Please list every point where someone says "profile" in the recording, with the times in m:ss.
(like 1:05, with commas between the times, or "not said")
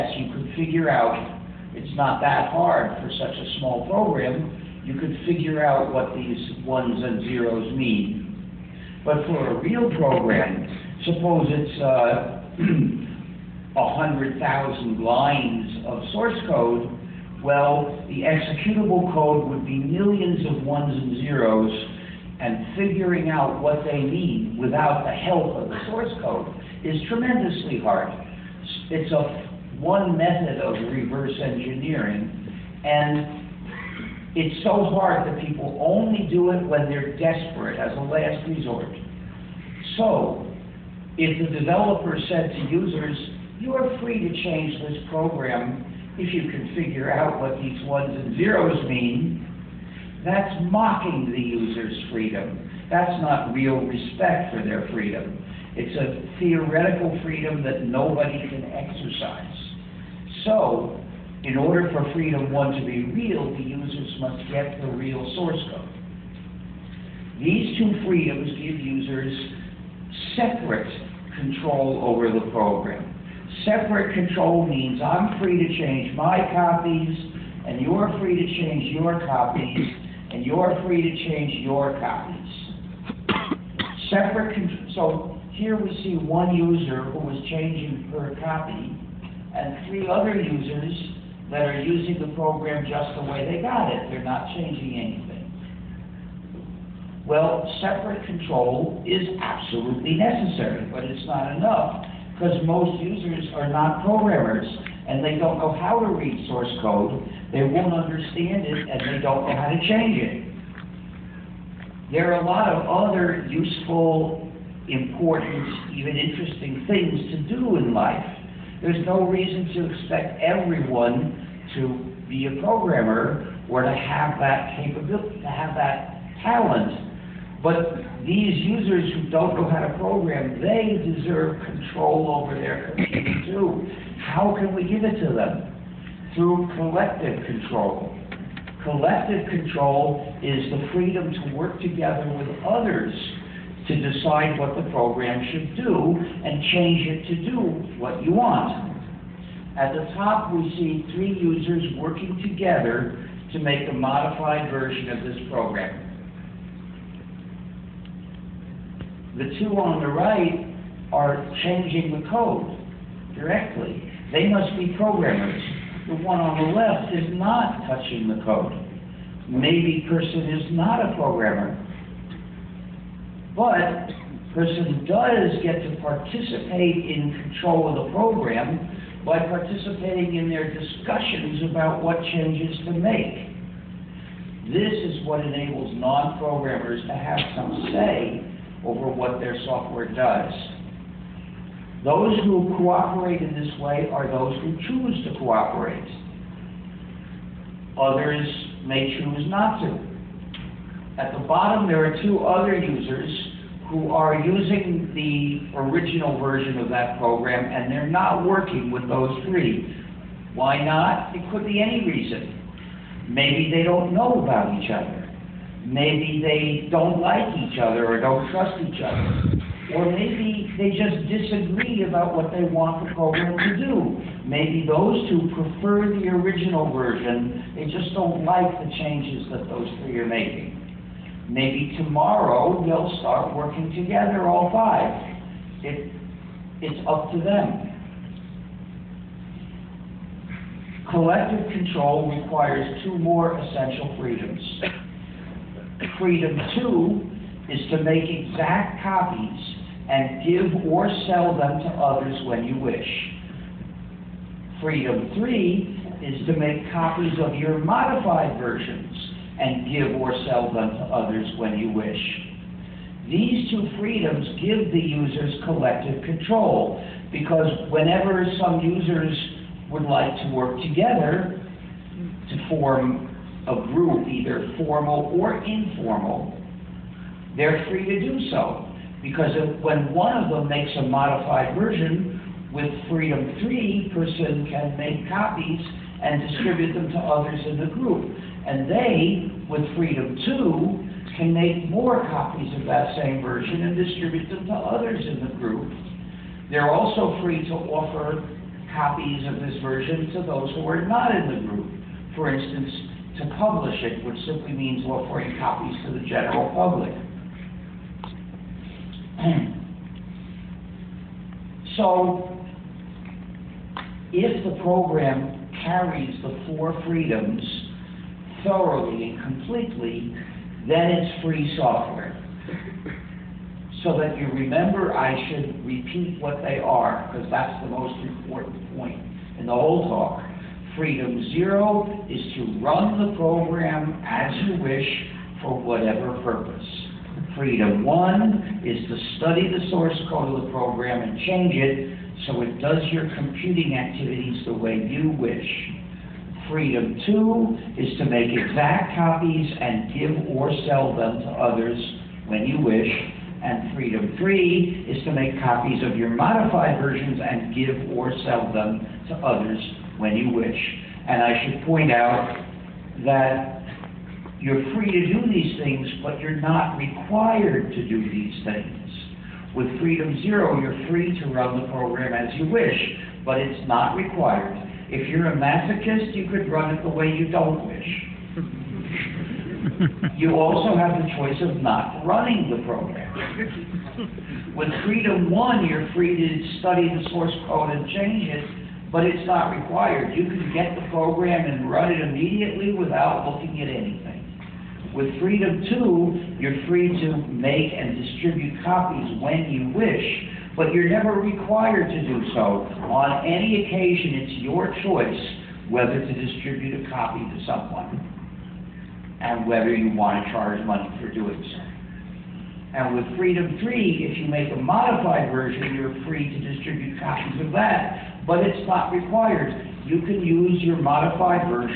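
not said.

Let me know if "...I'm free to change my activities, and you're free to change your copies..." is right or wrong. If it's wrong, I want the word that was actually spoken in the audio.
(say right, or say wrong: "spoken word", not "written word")
wrong: "copies", not "activities".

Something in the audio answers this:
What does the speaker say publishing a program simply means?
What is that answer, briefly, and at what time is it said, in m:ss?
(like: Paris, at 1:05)
Offering copies to the general public, at 5:05.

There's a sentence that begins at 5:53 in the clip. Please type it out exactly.
And freedom three is to make copies of your modified versions and give or sell them to others when you wish.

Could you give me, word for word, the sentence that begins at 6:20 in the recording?
you also have the choice of not running the program.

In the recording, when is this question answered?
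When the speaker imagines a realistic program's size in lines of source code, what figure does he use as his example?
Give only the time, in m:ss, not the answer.
0:13.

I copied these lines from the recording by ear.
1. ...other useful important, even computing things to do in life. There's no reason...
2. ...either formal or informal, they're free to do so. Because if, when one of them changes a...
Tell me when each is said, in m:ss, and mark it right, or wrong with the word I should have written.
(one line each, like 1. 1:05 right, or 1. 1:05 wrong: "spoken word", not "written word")
1. 1:52 wrong: "interesting", not "computing"
2. 4:34 wrong: "makes", not "changes".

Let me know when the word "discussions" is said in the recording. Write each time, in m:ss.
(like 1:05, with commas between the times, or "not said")
3:00.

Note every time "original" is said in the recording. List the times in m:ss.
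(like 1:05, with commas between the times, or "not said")
3:25, 3:46.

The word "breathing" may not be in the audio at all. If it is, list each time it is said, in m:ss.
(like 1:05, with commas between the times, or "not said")
not said.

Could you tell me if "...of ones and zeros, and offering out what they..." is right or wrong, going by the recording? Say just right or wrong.
wrong.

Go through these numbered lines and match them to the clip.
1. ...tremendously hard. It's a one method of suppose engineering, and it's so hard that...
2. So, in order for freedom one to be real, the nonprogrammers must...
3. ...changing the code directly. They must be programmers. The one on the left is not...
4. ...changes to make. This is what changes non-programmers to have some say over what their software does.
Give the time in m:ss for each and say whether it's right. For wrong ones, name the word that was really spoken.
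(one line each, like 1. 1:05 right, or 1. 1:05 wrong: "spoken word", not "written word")
1. 0:27 wrong: "reverse", not "suppose"
2. 1:00 wrong: "users", not "nonprogrammers"
3. 2:41 right
4. 3:02 wrong: "enables", not "changes".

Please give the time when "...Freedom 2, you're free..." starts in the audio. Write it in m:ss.
6:35.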